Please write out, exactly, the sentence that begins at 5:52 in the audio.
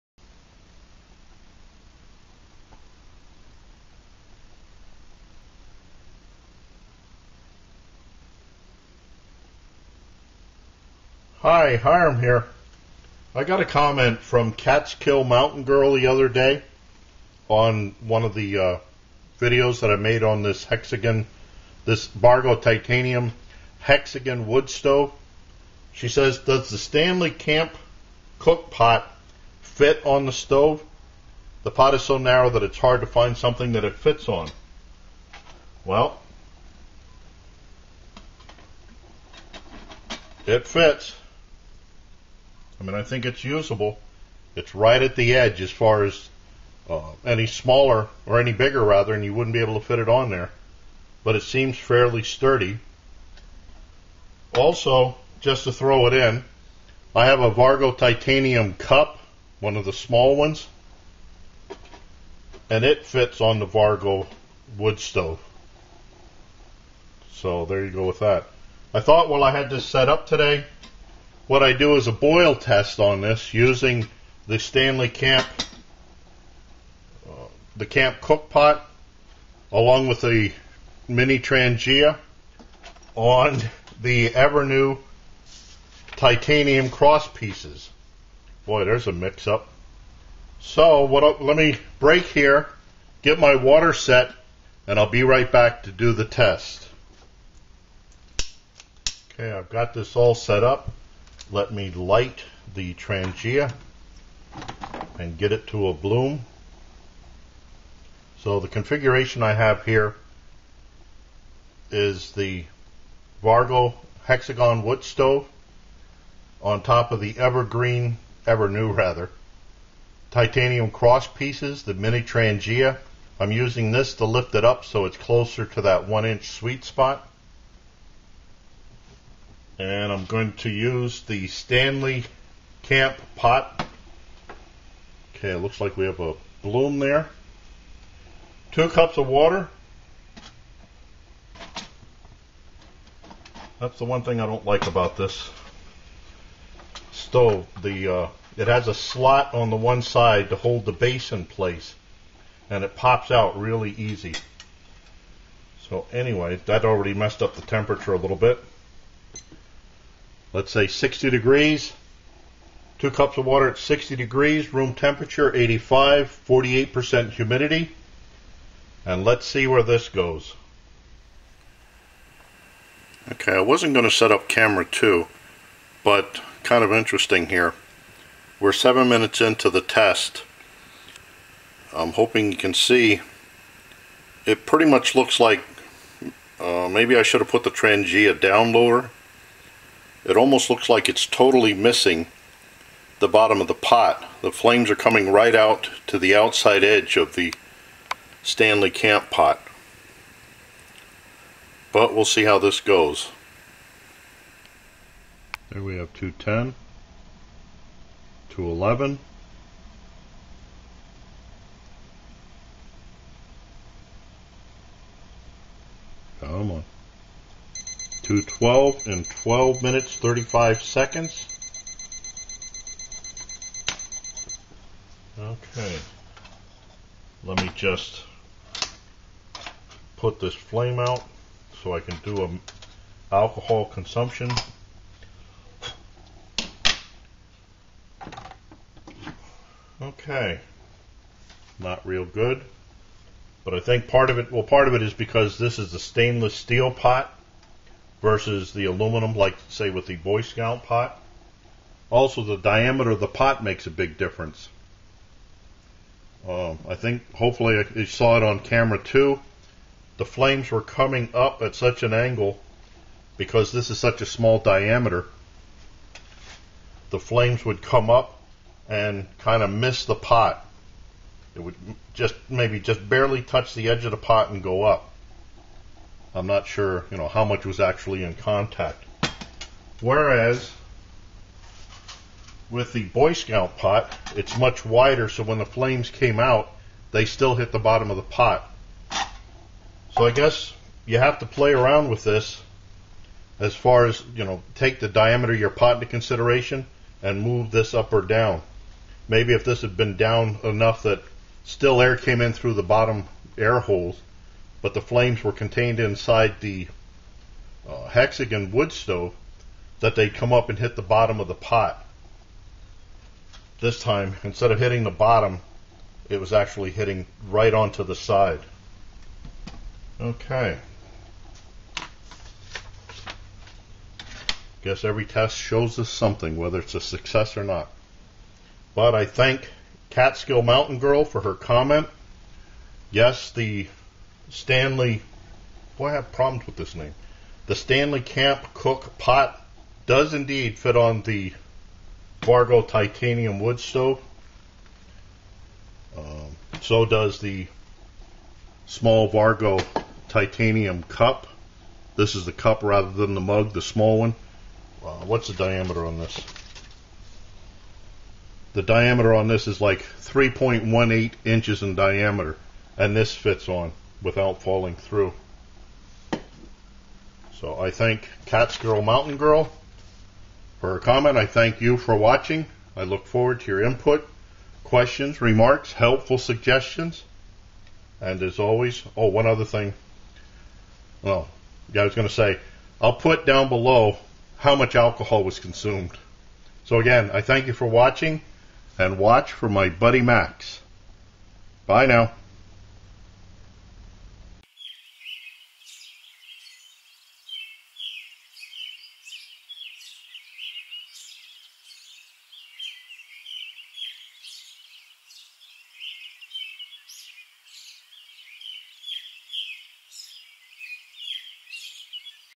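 This is the cup rather than the mug, the small one.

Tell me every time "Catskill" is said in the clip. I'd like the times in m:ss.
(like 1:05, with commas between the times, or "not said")
0:14, 5:30, 6:08.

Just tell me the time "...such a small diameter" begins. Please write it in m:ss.
4:23.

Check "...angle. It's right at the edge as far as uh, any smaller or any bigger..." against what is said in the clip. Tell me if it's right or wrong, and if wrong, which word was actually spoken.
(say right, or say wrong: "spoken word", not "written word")
wrong: "usable", not "angle".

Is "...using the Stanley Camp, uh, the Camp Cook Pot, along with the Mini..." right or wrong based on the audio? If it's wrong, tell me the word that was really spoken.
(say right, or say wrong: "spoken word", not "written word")
right.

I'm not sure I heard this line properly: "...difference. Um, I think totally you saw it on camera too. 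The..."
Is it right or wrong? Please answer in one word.
wrong.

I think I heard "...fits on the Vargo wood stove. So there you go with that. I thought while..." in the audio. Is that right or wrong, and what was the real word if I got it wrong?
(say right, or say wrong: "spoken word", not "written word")
right.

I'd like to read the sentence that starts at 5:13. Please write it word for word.
This time, instead of hitting the bottom, it was actually hitting right onto the side.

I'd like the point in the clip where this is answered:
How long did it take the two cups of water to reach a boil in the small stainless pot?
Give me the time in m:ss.
3:39.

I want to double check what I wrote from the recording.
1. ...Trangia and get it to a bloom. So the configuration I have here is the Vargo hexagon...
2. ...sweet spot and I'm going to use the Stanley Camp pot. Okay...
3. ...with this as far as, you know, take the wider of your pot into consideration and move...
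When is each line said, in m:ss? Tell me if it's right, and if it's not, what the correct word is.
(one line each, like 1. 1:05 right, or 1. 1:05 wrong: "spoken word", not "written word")
1. 1:42 right
2. 2:06 right
3. 4:52 wrong: "diameter", not "wider".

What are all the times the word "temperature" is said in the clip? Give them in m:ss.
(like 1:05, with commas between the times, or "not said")
2:37, 2:44.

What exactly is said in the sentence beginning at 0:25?
She says, Does the Stanley Camp cook pot fit on the stove?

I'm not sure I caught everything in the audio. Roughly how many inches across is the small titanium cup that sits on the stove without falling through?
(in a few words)
3.18 inches.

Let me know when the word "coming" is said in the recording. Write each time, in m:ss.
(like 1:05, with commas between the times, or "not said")
3:14, 4:20.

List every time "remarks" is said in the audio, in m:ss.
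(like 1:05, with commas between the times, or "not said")
6:15.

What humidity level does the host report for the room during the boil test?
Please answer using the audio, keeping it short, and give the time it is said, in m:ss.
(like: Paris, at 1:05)
48%, at 2:46.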